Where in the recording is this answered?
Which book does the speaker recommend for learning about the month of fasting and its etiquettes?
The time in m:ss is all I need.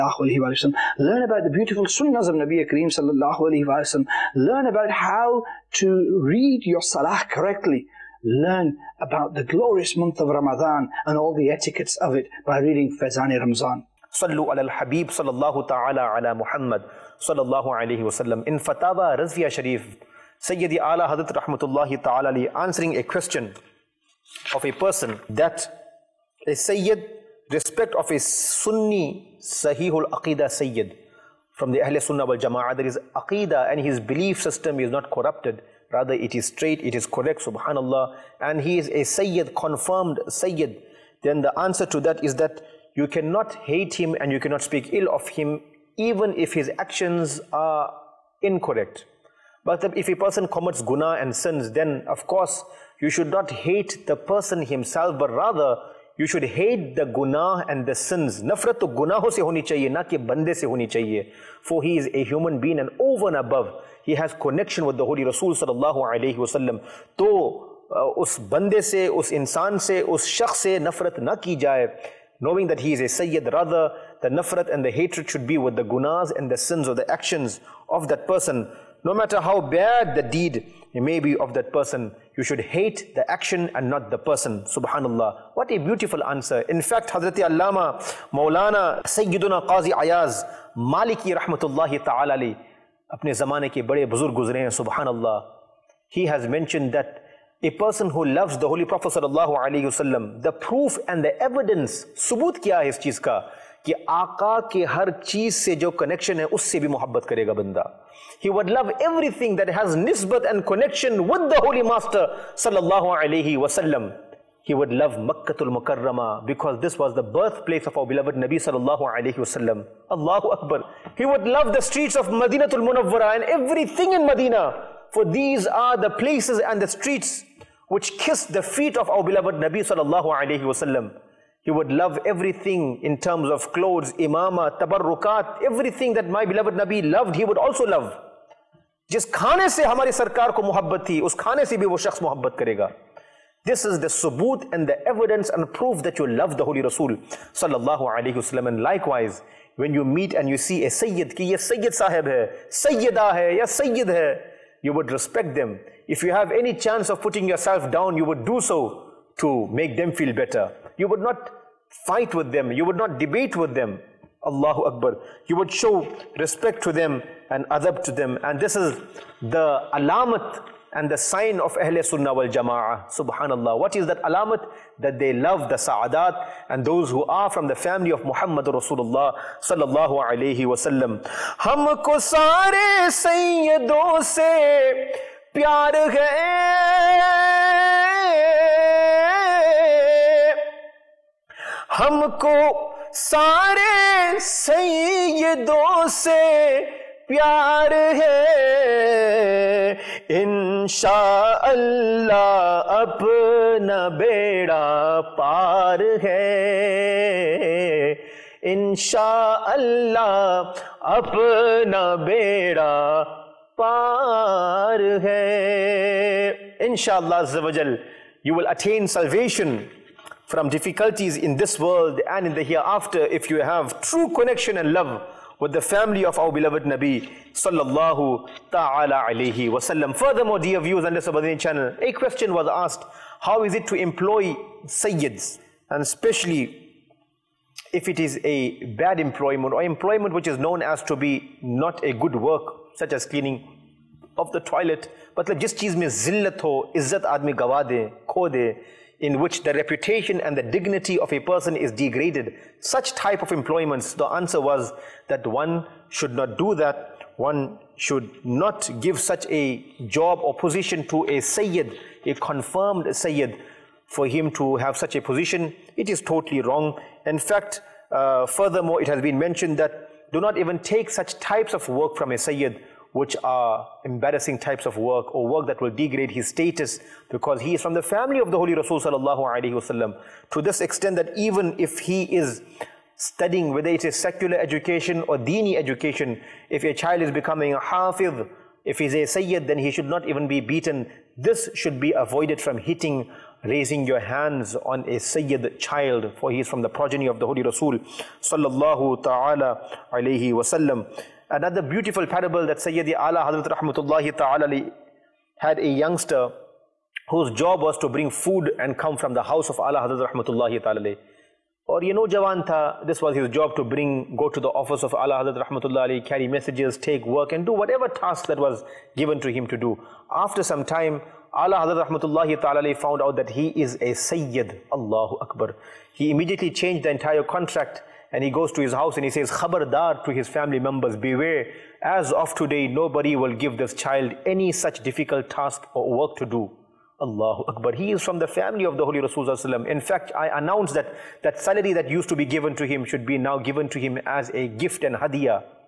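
0:12.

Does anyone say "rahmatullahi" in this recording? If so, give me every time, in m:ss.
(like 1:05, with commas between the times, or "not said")
0:21, 1:31, 5:03, 5:10, 5:15, 5:22.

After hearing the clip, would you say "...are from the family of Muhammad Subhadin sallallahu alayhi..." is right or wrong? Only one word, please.
wrong.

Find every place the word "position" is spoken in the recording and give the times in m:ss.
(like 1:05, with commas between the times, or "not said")
4:20, 4:25.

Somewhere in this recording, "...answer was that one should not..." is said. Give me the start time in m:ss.
4:14.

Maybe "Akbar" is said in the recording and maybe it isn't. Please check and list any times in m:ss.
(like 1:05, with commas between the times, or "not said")
2:00, 2:44, 5:25, 5:37.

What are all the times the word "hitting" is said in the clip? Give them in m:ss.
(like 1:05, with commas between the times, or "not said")
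4:52.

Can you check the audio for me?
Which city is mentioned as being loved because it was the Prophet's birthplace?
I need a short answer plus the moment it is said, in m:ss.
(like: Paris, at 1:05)
Makkatul Mukarrama, at 1:55.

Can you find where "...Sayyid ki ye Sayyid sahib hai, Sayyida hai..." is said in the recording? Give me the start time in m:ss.
2:30.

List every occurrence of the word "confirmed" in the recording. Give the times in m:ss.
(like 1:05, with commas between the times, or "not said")
0:39, 4:22.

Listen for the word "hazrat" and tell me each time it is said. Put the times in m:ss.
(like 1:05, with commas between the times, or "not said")
1:27, 5:03, 5:10, 5:15, 5:21.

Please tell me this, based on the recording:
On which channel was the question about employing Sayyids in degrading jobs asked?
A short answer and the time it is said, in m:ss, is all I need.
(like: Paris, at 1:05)
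Subhadin channel, at 3:51.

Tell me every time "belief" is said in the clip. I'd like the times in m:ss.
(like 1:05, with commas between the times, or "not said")
0:34.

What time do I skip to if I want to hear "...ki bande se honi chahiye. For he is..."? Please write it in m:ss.
1:00.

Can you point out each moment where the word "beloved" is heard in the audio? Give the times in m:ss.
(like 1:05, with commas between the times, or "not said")
1:58, 2:09, 2:16, 3:46.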